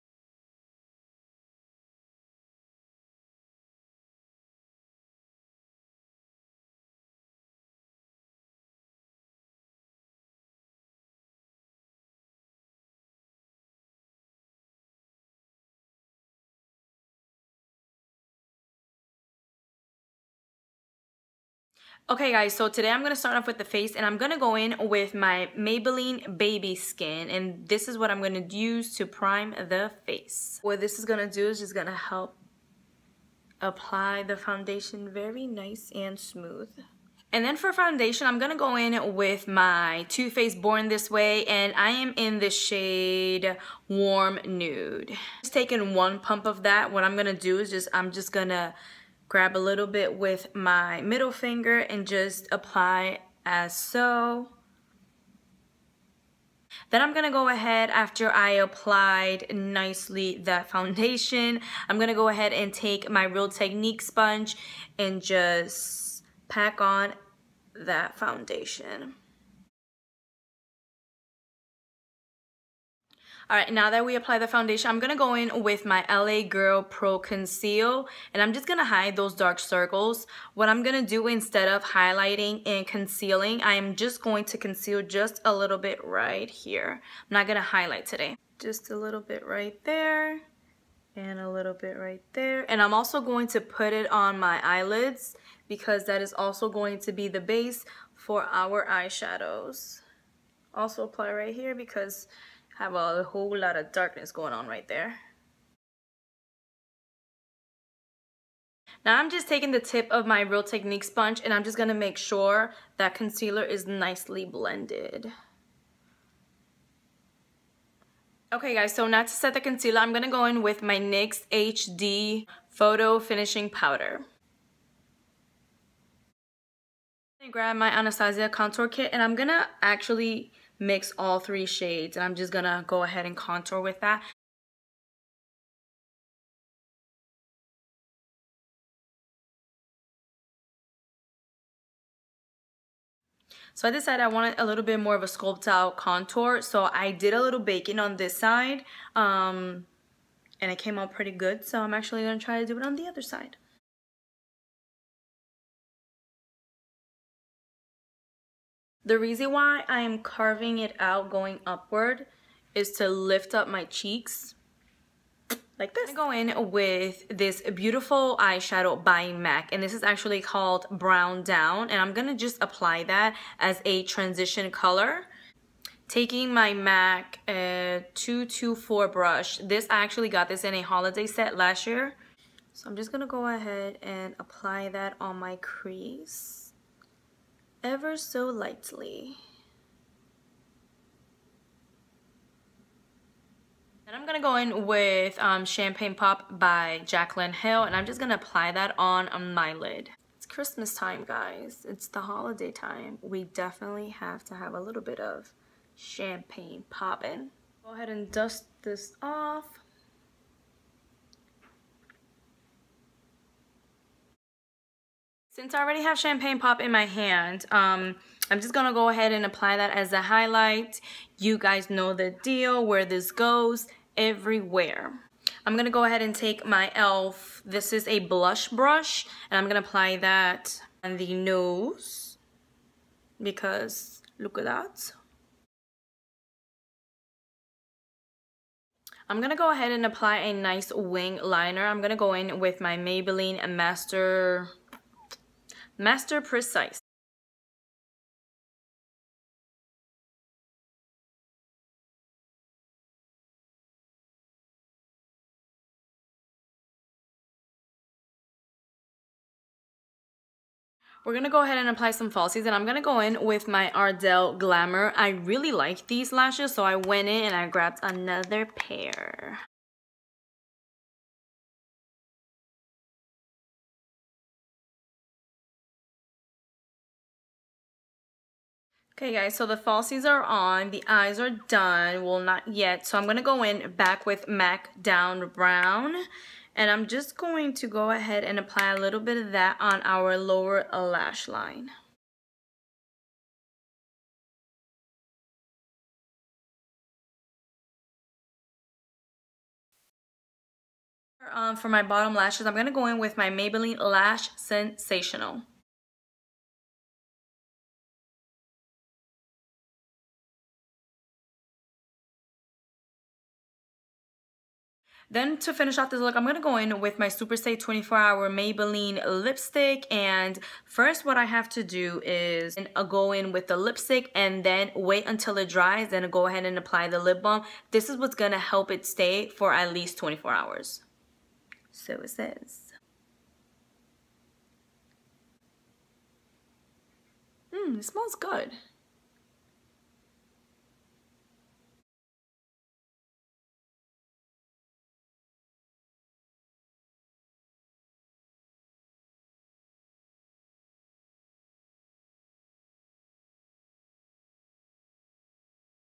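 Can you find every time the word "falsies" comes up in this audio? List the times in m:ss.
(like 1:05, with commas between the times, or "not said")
4:22, 4:39.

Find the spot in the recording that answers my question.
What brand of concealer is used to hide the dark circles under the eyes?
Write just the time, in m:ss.
1:16.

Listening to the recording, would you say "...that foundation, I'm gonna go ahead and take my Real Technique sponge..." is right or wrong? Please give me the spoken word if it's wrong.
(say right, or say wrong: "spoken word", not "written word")
right.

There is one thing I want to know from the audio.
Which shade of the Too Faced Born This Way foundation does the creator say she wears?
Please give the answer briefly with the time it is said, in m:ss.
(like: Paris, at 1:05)
Warm Nude, at 0:43.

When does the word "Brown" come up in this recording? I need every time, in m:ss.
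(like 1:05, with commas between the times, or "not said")
2:50, 4:45.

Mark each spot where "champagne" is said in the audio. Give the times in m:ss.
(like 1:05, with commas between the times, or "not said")
3:15, 3:25, 3:36.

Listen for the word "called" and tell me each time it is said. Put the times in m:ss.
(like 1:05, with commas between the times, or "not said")
2:50.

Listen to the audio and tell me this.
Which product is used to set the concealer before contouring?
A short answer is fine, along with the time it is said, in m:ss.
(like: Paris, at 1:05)
NYX HD Photo Finishing Powder, at 2:00.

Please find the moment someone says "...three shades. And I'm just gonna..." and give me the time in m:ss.
2:11.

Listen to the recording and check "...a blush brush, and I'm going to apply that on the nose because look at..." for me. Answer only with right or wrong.
right.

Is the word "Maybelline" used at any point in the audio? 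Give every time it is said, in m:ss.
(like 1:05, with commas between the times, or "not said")
0:25, 4:02, 5:03, 5:18.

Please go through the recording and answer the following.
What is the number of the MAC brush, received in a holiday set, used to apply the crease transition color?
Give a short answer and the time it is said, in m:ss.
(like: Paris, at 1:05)
224, at 2:58.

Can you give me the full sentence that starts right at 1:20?
What I'm gonna do instead of highlighting and concealing, I am just going to conceal just a little bit right here.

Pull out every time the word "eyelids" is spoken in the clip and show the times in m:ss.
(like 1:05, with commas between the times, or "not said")
1:34.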